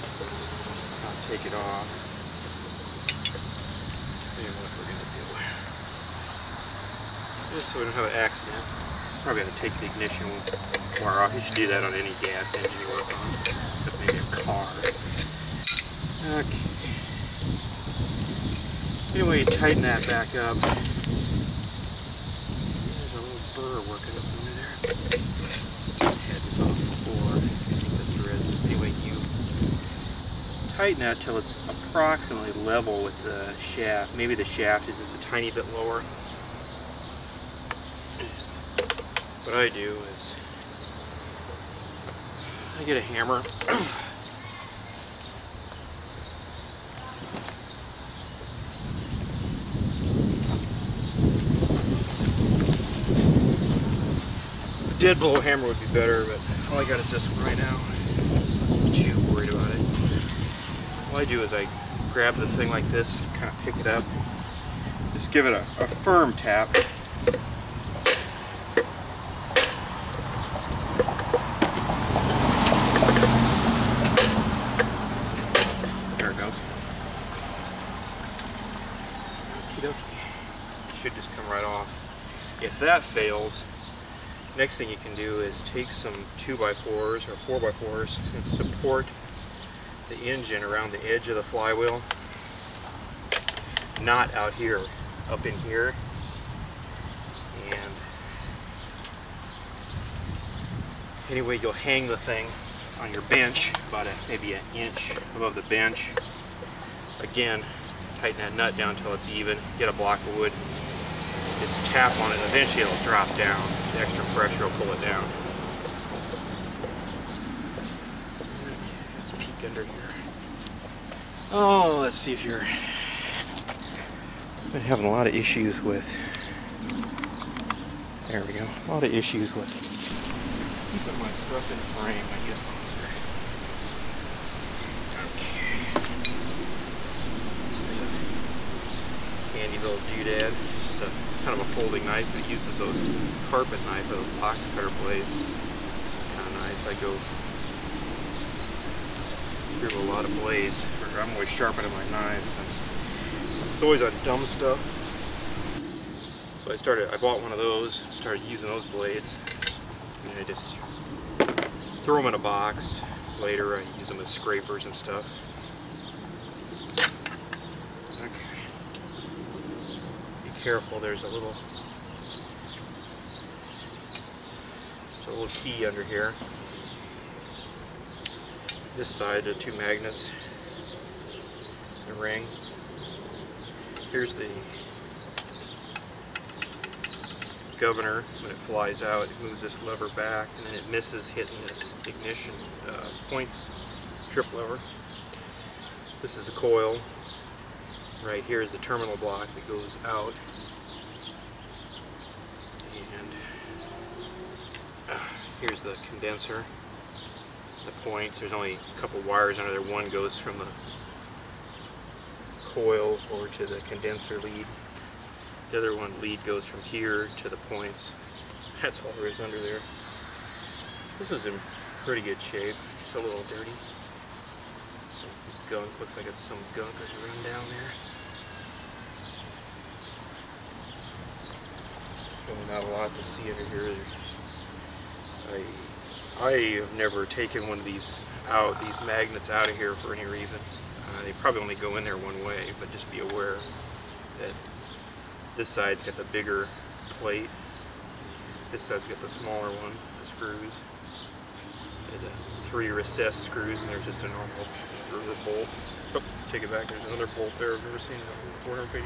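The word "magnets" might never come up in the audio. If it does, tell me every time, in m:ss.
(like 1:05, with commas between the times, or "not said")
2:59, 3:59.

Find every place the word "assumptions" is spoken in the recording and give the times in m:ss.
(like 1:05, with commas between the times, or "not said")
not said.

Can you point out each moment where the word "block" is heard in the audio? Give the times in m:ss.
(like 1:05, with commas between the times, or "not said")
1:49, 3:19.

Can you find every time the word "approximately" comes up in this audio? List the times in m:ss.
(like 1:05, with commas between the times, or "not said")
0:31.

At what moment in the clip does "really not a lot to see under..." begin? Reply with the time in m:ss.
3:52.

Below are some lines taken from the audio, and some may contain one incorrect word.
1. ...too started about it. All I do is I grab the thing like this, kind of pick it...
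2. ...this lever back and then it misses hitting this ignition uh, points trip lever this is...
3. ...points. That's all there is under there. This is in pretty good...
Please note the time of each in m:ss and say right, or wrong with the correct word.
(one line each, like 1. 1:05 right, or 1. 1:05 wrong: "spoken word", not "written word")
1. 0:58 wrong: "worried", not "started"
2. 3:09 right
3. 3:37 right.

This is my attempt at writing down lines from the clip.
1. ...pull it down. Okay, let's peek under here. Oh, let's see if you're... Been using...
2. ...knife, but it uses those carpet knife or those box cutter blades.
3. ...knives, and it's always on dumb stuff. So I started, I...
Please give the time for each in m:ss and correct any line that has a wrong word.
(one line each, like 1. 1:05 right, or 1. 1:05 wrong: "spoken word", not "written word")
1. 1:54 wrong: "having", not "using"
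2. 2:22 right
3. 2:32 right.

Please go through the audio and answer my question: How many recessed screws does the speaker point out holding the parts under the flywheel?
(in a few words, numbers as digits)
3.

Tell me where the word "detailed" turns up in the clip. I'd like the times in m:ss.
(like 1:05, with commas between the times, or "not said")
not said.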